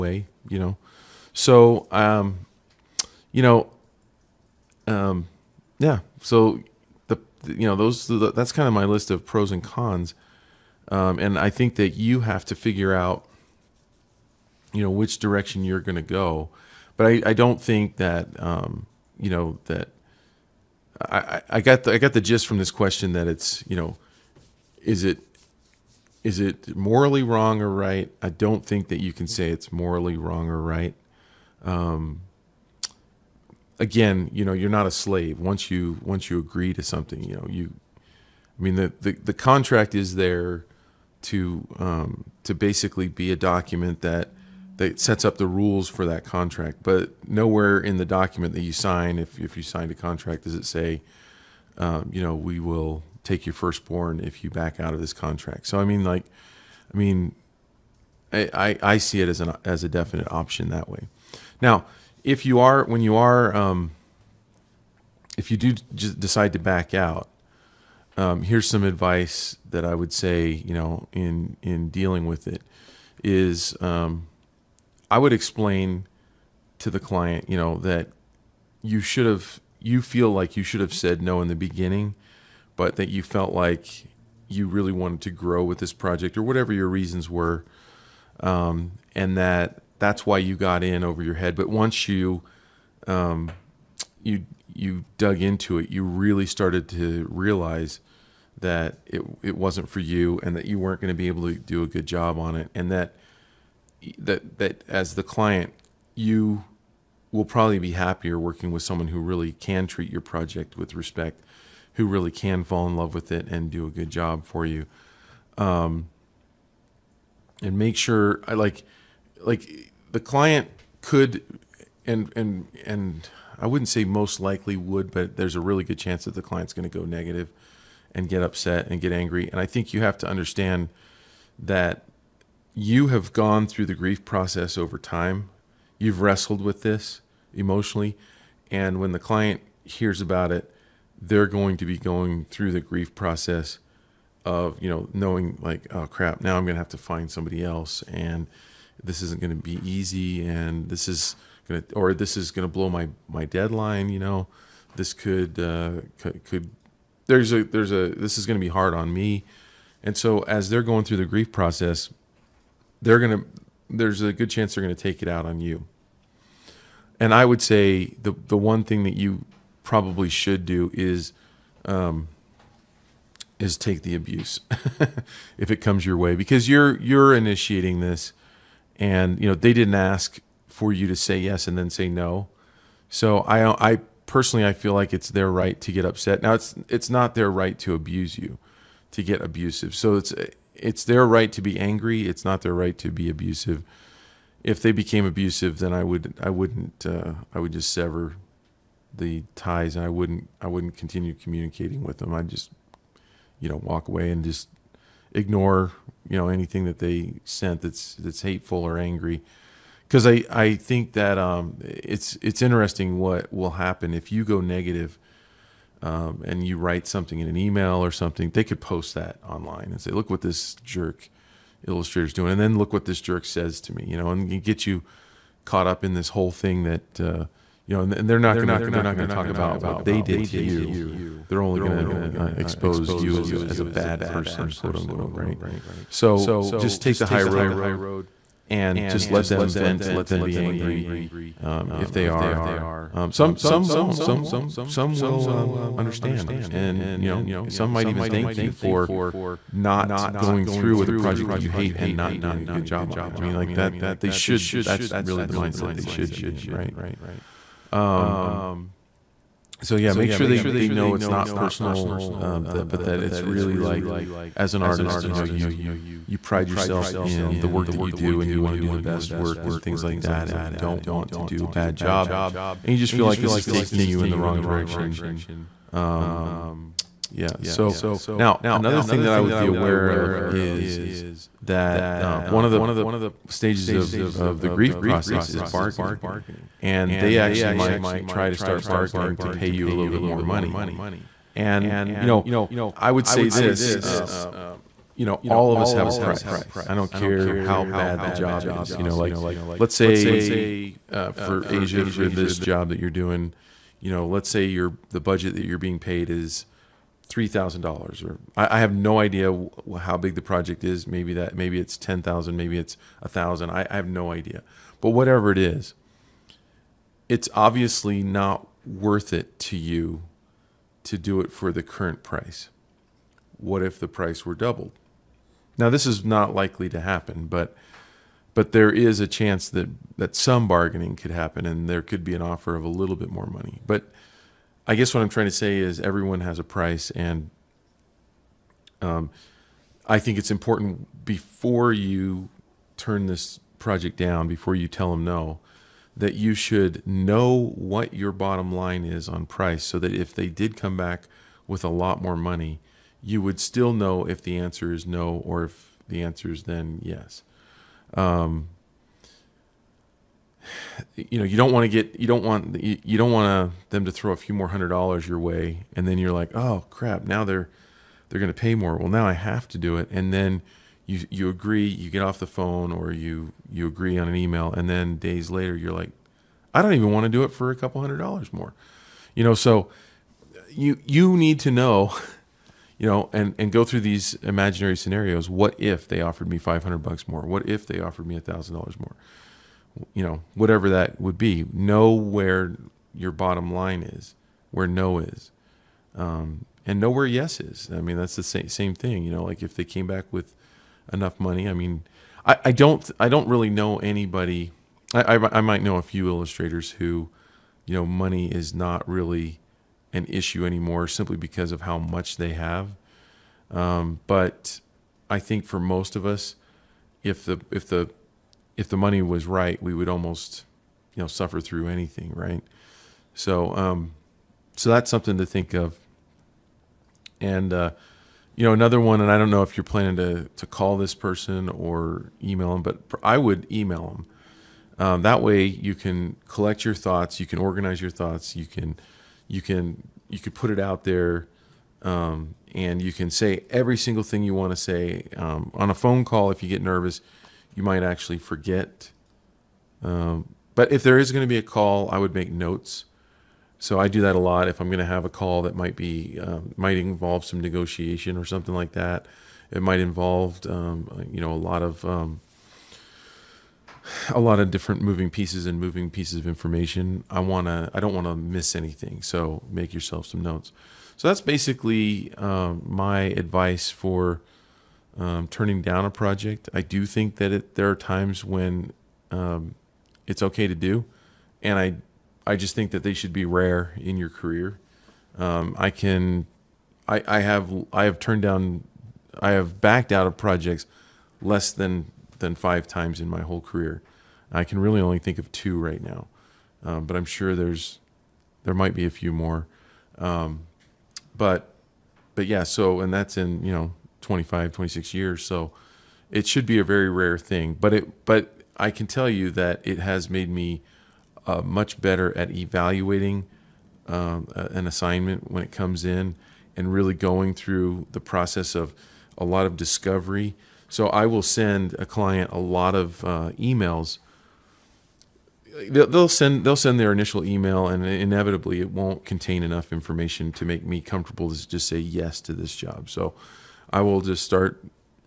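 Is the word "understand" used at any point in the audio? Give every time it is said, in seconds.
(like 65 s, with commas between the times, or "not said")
130 s, 245 s.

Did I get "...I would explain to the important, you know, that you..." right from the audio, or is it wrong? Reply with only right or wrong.
wrong.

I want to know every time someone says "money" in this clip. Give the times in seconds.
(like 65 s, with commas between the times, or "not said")
290 s, 333 s, 352 s, 401 s, 408 s, 418 s.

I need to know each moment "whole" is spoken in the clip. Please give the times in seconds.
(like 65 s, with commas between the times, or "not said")
226 s, 493 s.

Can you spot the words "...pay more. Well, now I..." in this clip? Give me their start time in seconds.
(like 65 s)
368 s.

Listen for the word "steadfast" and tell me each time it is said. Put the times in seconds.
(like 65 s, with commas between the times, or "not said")
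not said.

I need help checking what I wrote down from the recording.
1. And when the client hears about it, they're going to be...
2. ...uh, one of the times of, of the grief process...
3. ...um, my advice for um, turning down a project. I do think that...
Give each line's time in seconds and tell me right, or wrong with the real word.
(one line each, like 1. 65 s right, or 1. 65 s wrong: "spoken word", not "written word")
1. 138 s right
2. 282 s wrong: "stages", not "times"
3. 472 s right.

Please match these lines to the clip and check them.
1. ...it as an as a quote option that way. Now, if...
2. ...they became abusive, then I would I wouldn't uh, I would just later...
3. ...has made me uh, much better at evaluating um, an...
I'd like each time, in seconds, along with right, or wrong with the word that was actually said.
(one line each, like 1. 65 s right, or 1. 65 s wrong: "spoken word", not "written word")
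1. 59 s wrong: "definite", not "quote"
2. 194 s wrong: "sever", not "later"
3. 509 s right.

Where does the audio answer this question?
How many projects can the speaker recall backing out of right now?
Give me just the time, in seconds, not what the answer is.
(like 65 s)
495 s.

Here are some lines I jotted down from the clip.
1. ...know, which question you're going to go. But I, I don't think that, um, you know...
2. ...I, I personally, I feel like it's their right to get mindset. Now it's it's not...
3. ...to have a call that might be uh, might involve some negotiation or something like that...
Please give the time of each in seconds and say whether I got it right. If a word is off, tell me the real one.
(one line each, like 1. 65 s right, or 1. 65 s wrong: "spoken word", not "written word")
1. 14 s wrong: "direction", not "question"
2. 183 s wrong: "upset", not "mindset"
3. 454 s right.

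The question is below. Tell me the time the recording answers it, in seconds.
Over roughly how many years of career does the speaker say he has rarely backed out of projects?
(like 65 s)
504 s.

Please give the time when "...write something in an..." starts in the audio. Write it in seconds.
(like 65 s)
216 s.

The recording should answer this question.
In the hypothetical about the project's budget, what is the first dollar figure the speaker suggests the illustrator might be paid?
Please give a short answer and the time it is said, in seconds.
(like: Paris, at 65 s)
$3,000, at 307 s.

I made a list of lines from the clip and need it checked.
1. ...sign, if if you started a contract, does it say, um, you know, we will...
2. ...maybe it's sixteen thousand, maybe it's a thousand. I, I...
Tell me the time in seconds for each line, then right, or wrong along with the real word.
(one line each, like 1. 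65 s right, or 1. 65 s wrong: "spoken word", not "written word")
1. 48 s wrong: "signed", not "started"
2. 311 s wrong: "ten", not "sixteen".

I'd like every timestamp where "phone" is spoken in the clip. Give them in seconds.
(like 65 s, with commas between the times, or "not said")
372 s, 445 s.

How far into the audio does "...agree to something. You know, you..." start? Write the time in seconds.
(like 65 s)
36 s.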